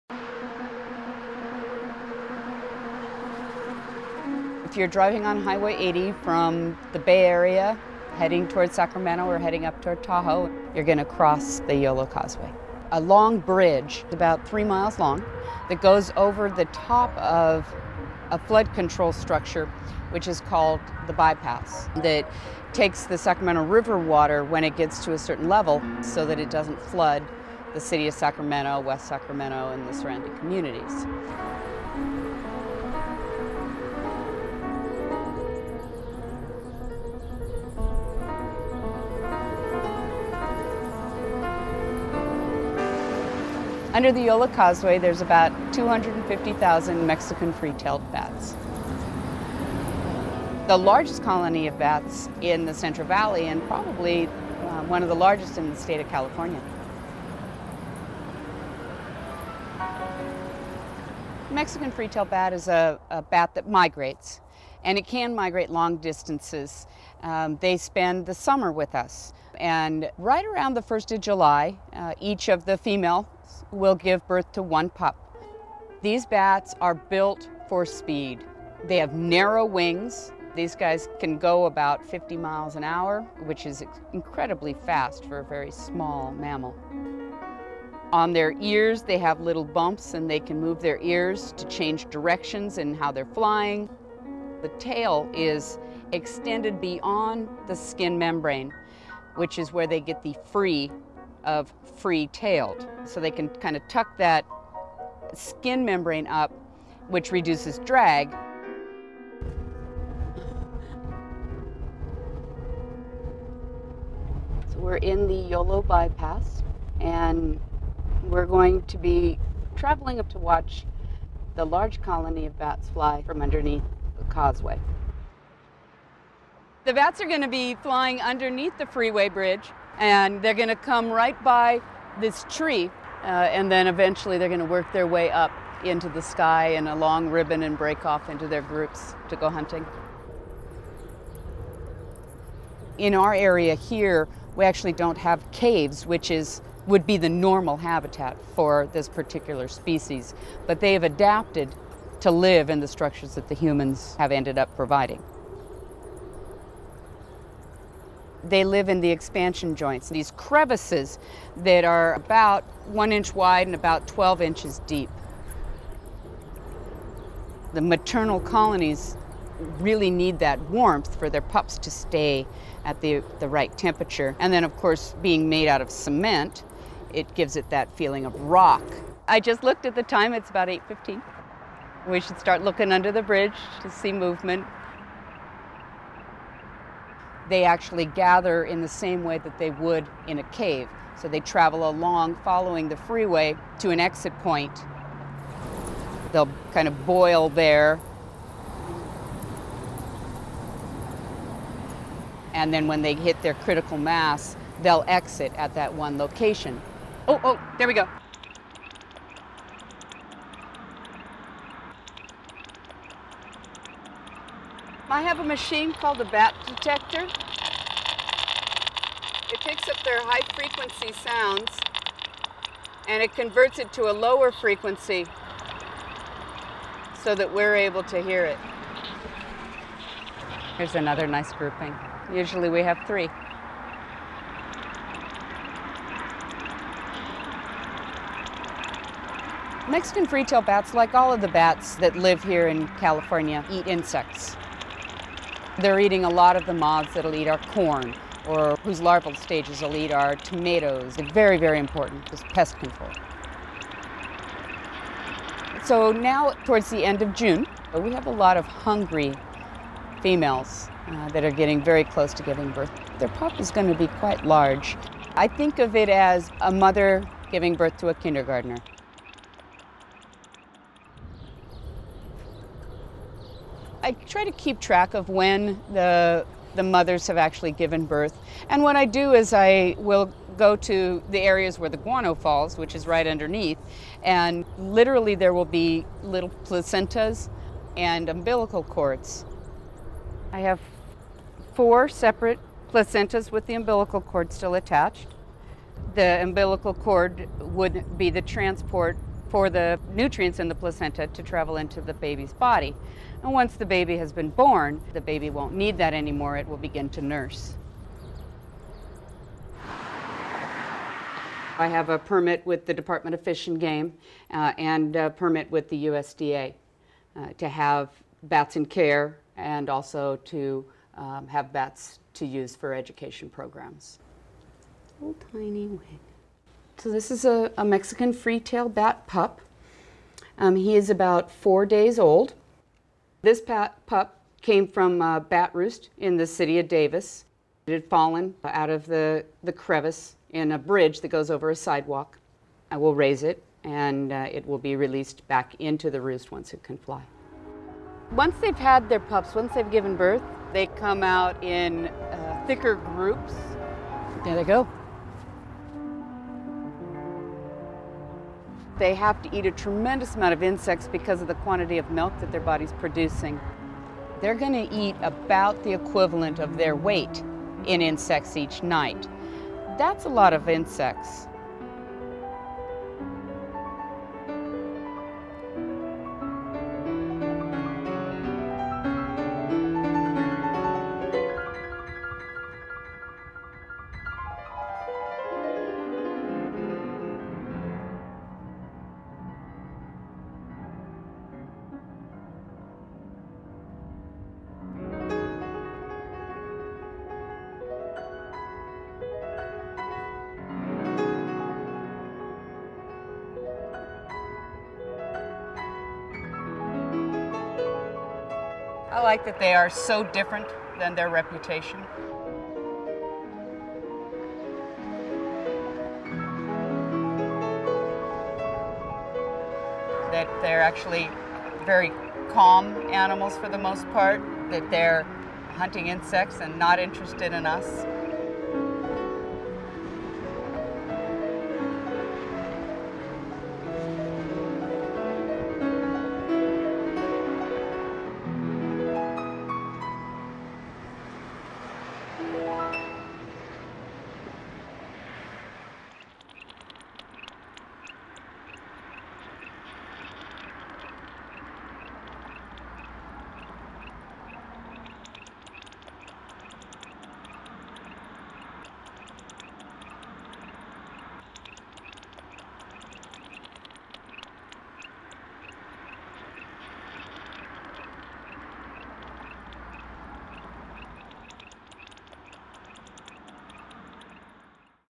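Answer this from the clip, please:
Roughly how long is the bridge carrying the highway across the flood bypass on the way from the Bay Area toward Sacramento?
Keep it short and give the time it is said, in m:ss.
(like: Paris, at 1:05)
3 miles, at 0:14.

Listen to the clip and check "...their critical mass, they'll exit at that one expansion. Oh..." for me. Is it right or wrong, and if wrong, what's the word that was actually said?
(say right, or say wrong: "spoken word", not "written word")
wrong: "location", not "expansion".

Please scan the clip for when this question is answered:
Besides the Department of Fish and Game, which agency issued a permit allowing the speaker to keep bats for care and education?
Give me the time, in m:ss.
5:16.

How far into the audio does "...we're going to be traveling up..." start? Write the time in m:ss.
1:58.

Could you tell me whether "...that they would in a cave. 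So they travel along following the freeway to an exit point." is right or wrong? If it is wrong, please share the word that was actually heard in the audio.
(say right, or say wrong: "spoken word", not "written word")
right.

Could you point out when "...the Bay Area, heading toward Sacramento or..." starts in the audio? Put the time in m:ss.
0:06.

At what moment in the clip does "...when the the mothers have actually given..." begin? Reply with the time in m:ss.
4:35.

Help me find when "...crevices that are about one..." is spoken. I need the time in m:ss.
2:40.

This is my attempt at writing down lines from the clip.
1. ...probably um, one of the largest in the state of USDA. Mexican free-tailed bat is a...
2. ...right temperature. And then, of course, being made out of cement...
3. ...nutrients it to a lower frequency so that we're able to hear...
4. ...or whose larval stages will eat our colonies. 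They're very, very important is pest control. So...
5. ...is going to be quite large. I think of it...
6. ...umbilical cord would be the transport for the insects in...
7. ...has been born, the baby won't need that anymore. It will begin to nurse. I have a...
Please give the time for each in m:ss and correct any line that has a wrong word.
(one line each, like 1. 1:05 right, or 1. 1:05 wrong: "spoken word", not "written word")
1. 0:53 wrong: "California", not "USDA"
2. 2:53 right
3. 3:43 wrong: "converts", not "nutrients"
4. 4:08 wrong: "tomatoes", not "colonies"
5. 4:23 right
6. 4:56 wrong: "nutrients", not "insects"
7. 5:04 right.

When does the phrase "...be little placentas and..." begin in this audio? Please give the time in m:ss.
4:45.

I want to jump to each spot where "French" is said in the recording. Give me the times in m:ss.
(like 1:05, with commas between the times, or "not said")
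not said.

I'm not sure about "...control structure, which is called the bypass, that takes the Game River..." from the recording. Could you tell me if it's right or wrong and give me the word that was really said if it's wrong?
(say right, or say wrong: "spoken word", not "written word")
wrong: "Sacramento", not "Game".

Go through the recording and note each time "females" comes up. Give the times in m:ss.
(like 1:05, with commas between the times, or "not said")
1:12, 4:20.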